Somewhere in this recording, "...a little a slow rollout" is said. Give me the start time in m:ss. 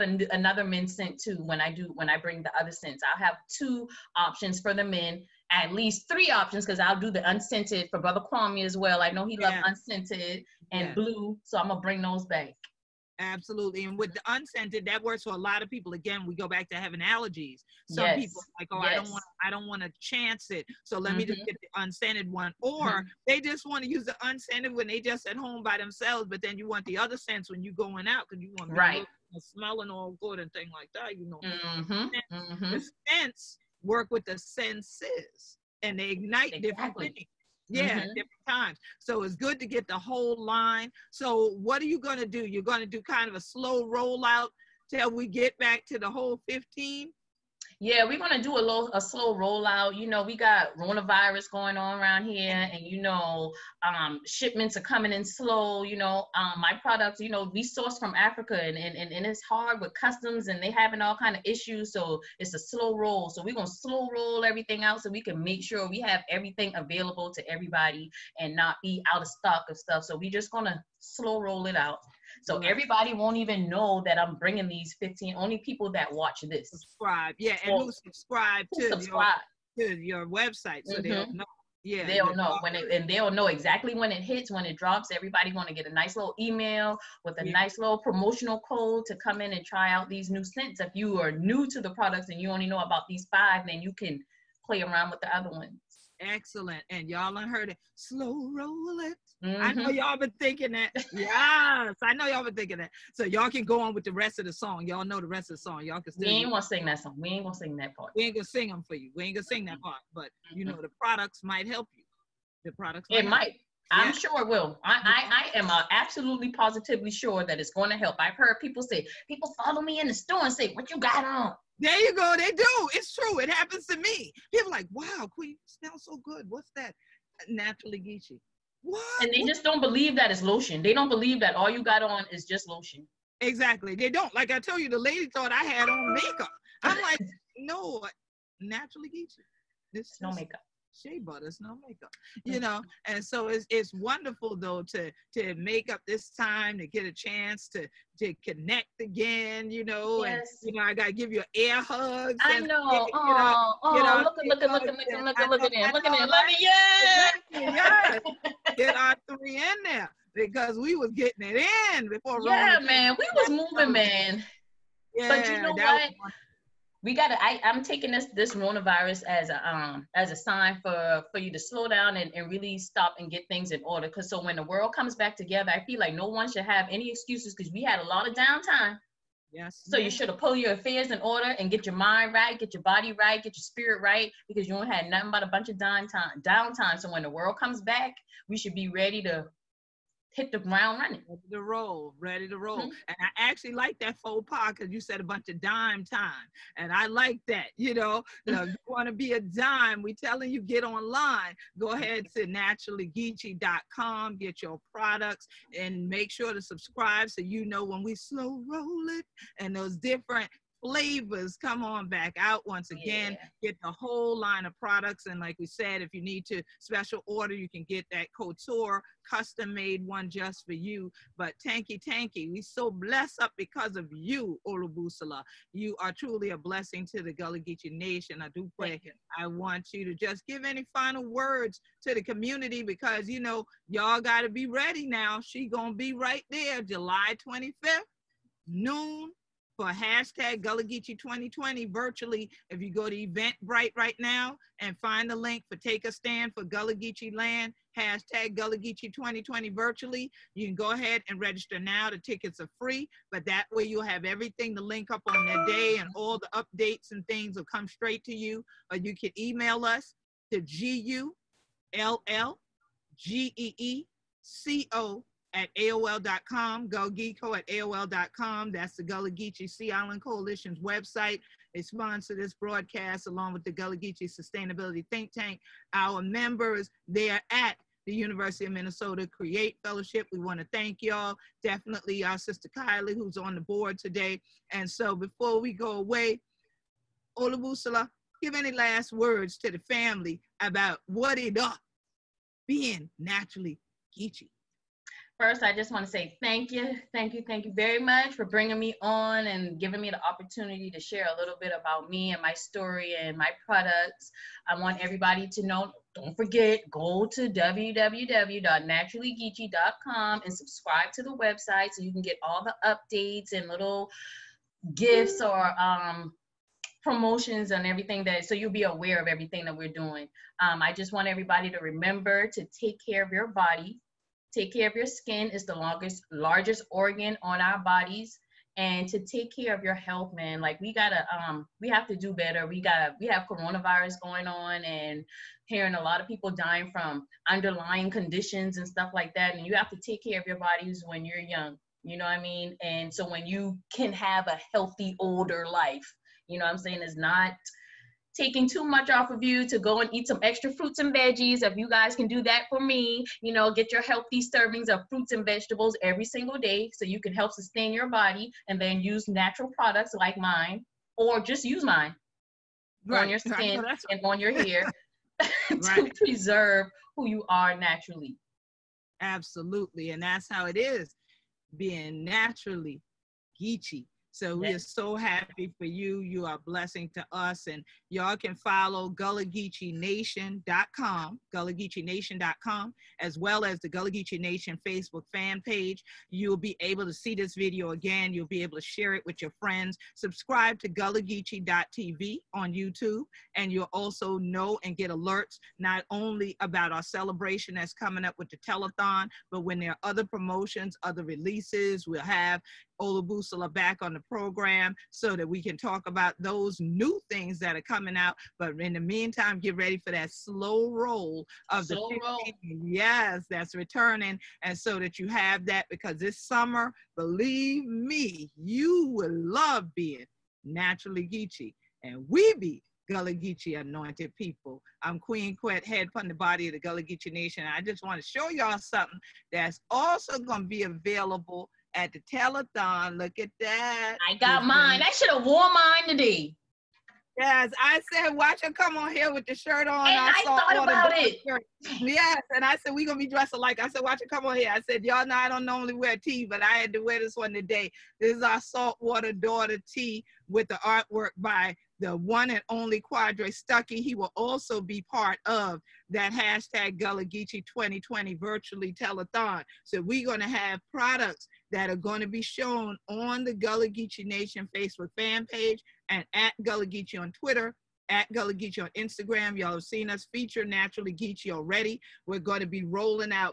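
0:48.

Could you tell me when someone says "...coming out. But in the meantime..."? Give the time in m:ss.
6:47.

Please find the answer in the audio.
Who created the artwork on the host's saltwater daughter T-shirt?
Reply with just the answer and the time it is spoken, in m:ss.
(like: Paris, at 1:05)
Quadre Stucky, at 7:33.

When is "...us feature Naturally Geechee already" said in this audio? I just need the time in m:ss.
7:50.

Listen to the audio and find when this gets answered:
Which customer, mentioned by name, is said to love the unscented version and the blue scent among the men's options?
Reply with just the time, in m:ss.
0:07.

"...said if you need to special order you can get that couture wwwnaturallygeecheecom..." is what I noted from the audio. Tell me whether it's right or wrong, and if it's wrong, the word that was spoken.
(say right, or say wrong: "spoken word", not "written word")
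wrong: "custom", not "wwwnaturallygeecheecom".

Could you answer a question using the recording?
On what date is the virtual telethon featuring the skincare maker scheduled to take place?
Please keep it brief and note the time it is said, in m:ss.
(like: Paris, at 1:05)
July 25th, at 3:56.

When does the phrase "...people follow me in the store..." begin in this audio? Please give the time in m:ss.
1:59.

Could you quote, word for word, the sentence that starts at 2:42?
Yeah, Rona man, we was moving, man.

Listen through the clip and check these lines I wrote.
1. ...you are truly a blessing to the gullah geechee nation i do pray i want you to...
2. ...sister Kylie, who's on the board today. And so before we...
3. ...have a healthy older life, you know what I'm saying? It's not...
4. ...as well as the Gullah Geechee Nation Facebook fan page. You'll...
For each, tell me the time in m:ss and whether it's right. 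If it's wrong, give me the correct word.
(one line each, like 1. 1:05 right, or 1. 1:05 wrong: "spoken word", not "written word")
1. 3:45 right
2. 4:42 right
3. 5:44 right
4. 6:23 right.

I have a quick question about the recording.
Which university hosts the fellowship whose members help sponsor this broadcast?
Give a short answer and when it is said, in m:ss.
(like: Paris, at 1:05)
University of Minnesota, at 4:38.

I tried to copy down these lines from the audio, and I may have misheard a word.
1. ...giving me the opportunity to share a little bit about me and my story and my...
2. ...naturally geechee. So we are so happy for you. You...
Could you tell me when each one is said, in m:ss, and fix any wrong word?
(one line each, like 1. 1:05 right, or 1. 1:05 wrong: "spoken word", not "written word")
1. 4:59 right
2. 6:12 right.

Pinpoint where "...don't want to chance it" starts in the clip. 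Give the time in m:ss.
0:19.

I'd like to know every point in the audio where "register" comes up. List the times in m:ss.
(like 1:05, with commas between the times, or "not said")
4:11.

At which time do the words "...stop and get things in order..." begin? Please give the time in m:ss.
2:52.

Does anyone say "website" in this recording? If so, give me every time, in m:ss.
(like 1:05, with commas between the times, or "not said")
1:20, 4:30, 5:11.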